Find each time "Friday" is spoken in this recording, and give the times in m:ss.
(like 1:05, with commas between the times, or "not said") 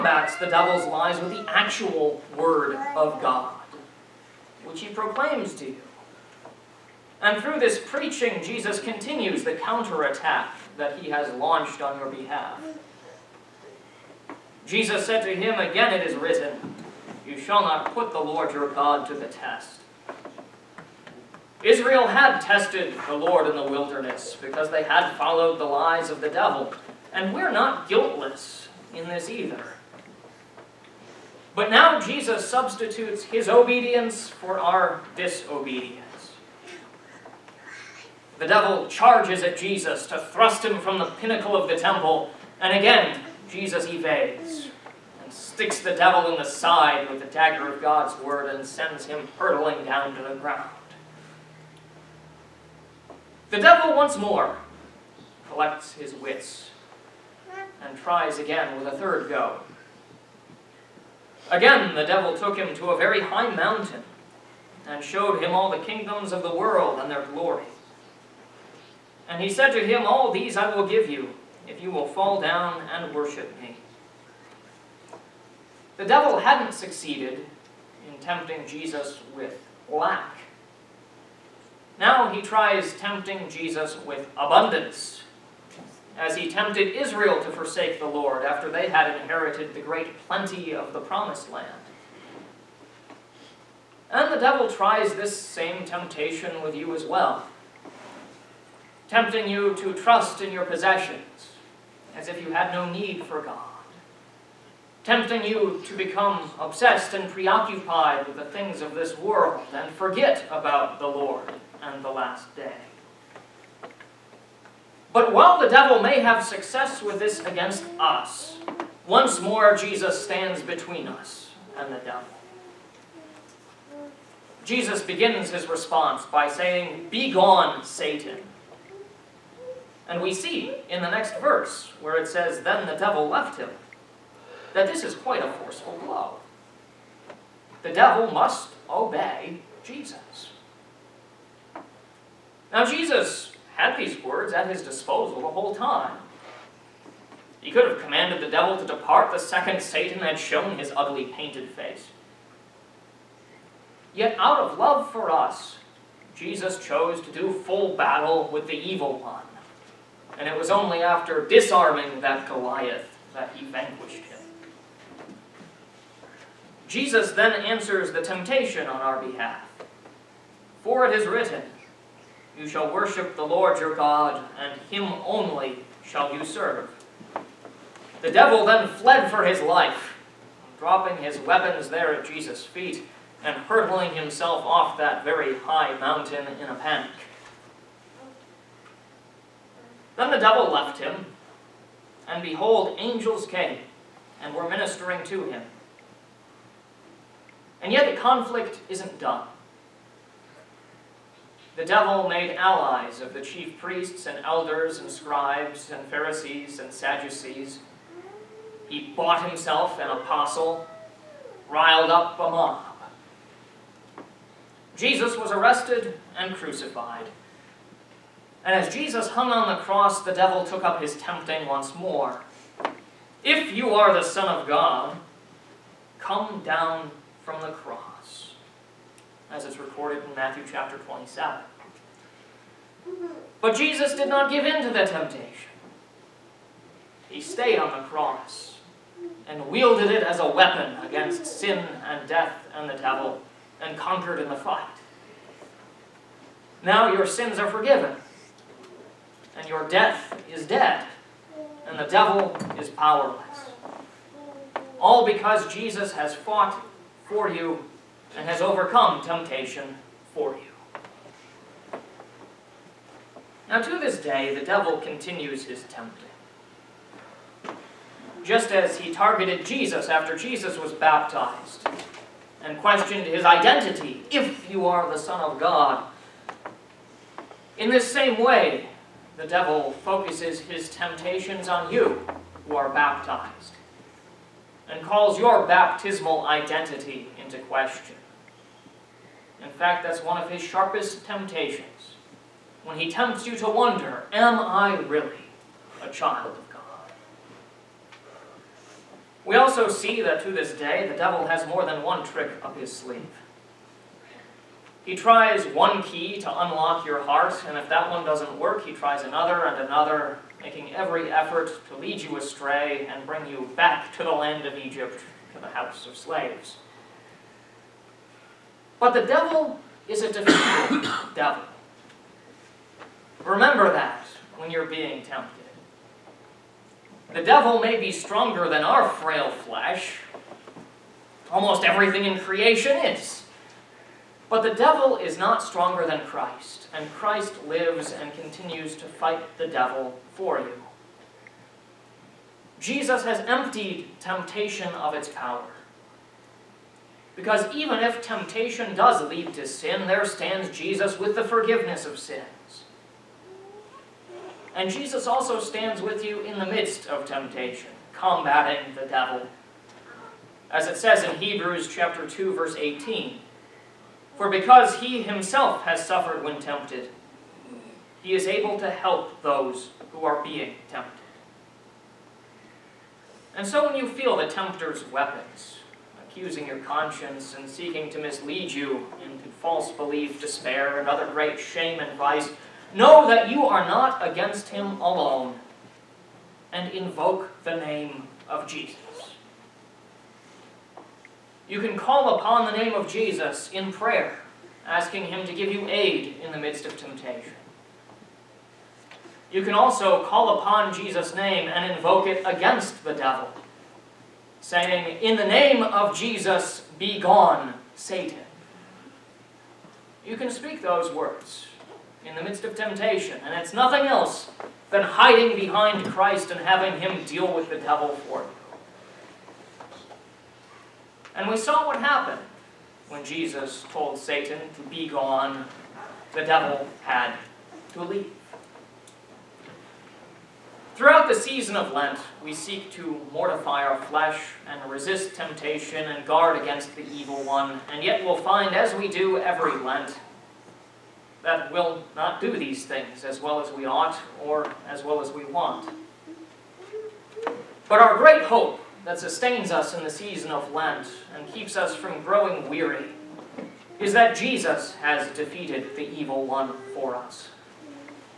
not said.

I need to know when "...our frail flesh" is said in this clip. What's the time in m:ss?
5:28.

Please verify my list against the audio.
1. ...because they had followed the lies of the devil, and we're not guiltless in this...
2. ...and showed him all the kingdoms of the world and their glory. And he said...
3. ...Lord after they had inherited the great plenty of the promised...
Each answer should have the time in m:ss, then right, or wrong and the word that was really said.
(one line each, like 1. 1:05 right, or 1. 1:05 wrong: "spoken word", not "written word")
1. 0:24 right
2. 1:04 right
3. 1:28 right.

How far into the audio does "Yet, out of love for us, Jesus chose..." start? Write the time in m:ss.
2:34.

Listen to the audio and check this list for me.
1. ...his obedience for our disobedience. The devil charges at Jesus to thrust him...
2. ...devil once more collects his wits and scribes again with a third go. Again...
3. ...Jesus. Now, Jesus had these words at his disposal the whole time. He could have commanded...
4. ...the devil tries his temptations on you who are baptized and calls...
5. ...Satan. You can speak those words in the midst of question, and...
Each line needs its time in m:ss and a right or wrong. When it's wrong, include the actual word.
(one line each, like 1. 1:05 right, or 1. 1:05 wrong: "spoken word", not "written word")
1. 0:33 right
2. 0:53 wrong: "tries", not "scribes"
3. 2:19 right
4. 4:39 wrong: "focuses", not "tries"
5. 6:47 wrong: "temptation", not "question".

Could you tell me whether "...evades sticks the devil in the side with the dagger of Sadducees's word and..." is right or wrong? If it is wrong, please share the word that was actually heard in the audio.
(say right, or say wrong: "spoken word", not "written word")
wrong: "God", not "Sadducees".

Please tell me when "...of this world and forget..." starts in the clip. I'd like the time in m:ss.
1:48.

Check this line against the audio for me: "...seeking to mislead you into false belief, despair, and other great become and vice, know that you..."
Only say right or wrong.
wrong.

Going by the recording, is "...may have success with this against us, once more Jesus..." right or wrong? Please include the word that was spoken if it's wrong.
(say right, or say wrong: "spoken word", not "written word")
right.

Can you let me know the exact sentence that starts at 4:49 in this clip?
In fact, that's one of his sharpest temptations.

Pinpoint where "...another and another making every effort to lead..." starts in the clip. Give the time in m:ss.
5:09.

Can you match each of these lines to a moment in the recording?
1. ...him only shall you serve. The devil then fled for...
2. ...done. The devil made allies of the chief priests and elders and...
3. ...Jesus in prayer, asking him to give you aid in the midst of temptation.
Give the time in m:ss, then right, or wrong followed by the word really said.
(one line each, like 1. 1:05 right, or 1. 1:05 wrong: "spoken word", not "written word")
1. 2:54 right
2. 3:19 right
3. 6:33 right.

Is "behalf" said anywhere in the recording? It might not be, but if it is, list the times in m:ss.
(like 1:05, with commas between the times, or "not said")
0:12, 2:49.